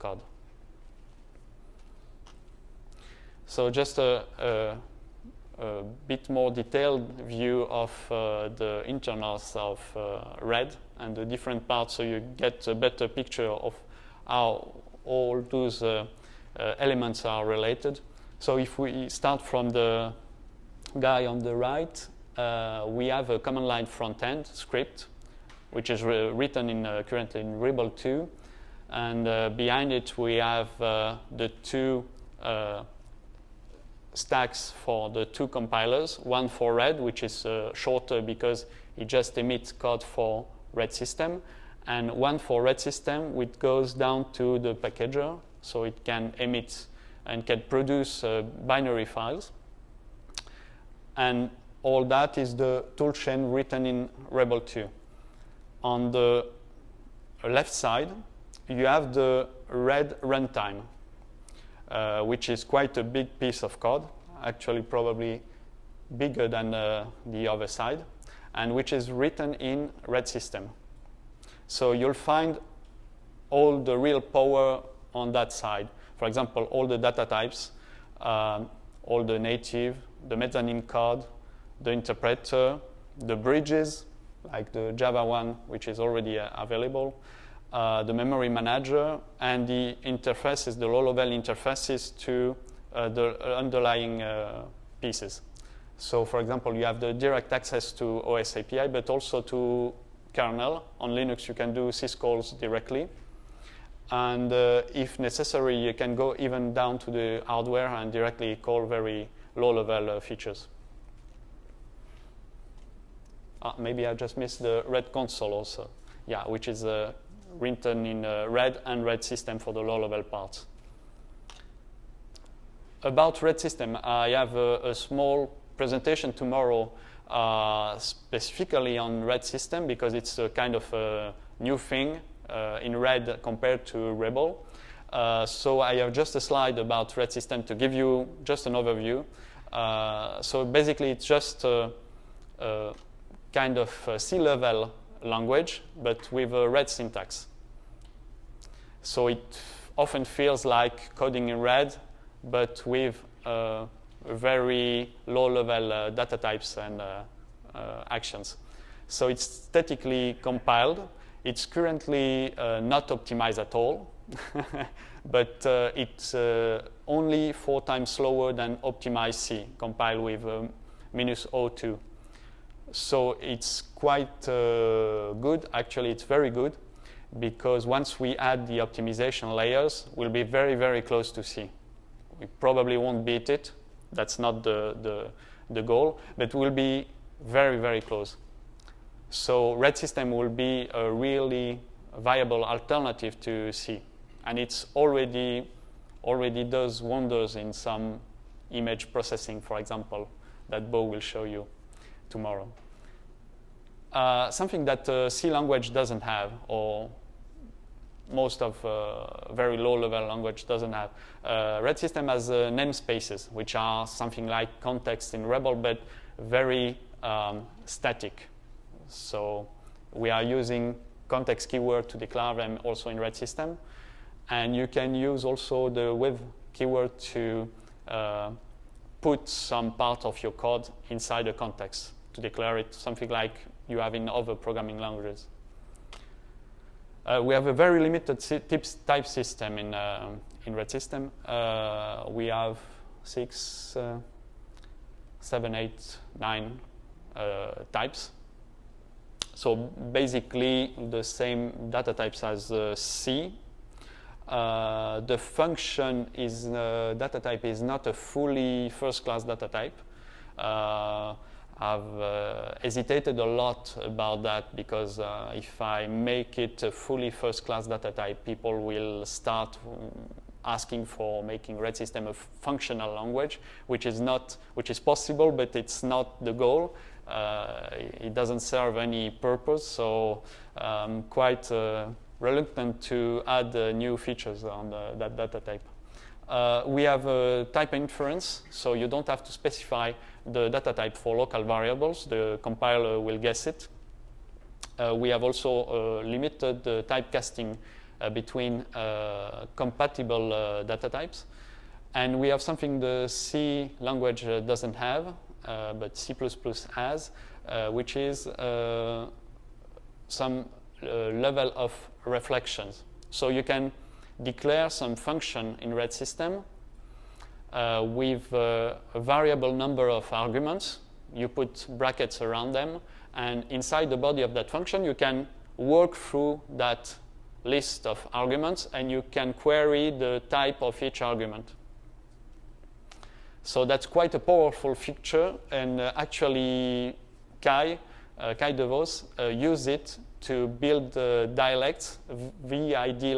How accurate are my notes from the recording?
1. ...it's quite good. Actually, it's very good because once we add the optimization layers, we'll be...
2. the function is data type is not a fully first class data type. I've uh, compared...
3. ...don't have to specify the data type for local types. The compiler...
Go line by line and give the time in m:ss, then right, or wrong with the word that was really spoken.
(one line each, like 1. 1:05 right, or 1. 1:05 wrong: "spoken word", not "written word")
1. 2:53 right
2. 4:14 wrong: "hesitated", not "compared"
3. 4:49 wrong: "variables", not "types".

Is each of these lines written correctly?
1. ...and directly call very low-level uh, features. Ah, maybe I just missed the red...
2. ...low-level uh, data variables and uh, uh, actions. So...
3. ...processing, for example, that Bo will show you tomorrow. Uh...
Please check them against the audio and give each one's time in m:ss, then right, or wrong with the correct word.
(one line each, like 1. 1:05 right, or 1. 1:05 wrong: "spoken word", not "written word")
1. 1:47 right
2. 2:35 wrong: "types", not "variables"
3. 3:19 right.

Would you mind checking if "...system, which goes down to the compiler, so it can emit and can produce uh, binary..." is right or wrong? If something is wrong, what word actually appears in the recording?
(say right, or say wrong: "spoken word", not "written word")
wrong: "packager", not "compiler".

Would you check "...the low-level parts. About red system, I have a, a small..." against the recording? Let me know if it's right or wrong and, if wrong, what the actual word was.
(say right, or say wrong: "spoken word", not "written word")
right.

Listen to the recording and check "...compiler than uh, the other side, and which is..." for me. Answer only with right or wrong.
wrong.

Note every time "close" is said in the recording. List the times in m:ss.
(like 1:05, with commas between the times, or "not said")
3:01, 3:07.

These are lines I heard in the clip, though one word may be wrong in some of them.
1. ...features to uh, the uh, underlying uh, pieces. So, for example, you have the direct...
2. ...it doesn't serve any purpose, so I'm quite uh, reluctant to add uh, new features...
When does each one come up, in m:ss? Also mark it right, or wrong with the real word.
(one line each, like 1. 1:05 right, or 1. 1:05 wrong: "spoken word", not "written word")
1. 1:31 wrong: "interfaces", not "features"
2. 4:37 right.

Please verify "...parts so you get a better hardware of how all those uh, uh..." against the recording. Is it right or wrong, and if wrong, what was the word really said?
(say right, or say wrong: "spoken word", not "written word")
wrong: "picture", not "hardware".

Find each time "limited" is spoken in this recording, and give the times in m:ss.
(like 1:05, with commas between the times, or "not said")
3:57, 4:56.